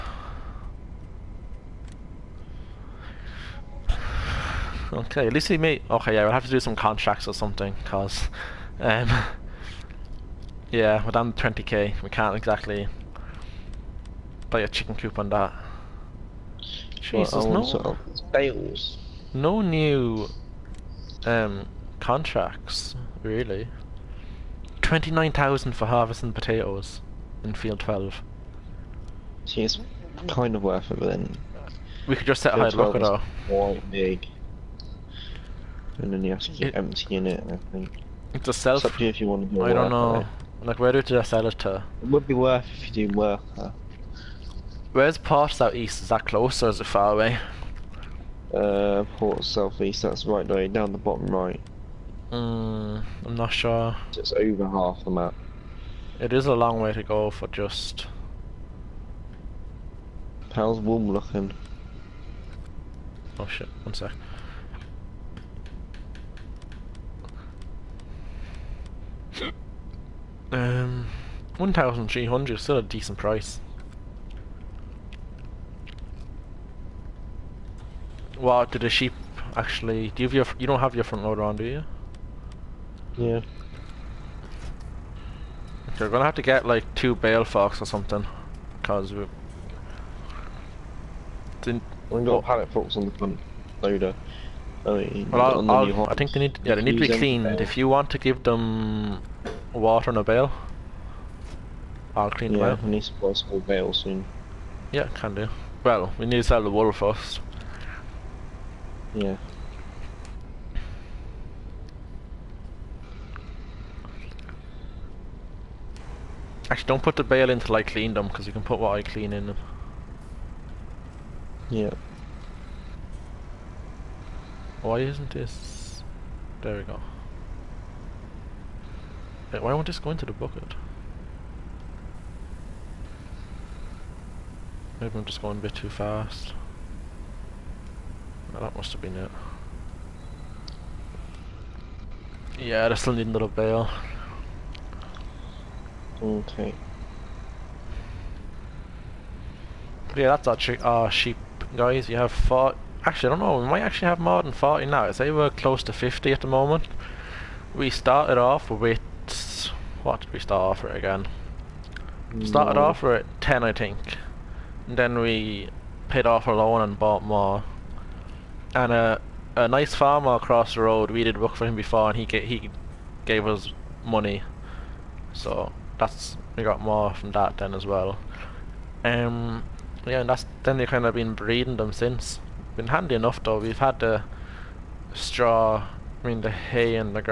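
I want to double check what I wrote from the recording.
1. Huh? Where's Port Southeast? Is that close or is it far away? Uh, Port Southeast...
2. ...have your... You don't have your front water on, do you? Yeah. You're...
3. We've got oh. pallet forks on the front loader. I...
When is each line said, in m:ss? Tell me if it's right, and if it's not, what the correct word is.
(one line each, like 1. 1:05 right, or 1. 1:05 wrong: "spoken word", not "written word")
1. 0:43 right
2. 1:20 wrong: "loader", not "water"
3. 1:32 right.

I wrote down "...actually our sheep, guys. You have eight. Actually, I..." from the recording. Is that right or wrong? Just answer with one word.
wrong.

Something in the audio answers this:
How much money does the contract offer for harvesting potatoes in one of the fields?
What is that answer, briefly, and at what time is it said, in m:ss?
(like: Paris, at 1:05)
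29,000, at 0:24.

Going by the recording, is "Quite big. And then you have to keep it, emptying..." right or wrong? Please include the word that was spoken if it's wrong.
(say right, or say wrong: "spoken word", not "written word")
right.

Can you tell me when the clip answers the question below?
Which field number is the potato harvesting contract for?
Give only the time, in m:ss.
0:27.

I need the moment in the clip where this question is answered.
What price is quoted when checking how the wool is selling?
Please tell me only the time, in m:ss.
1:11.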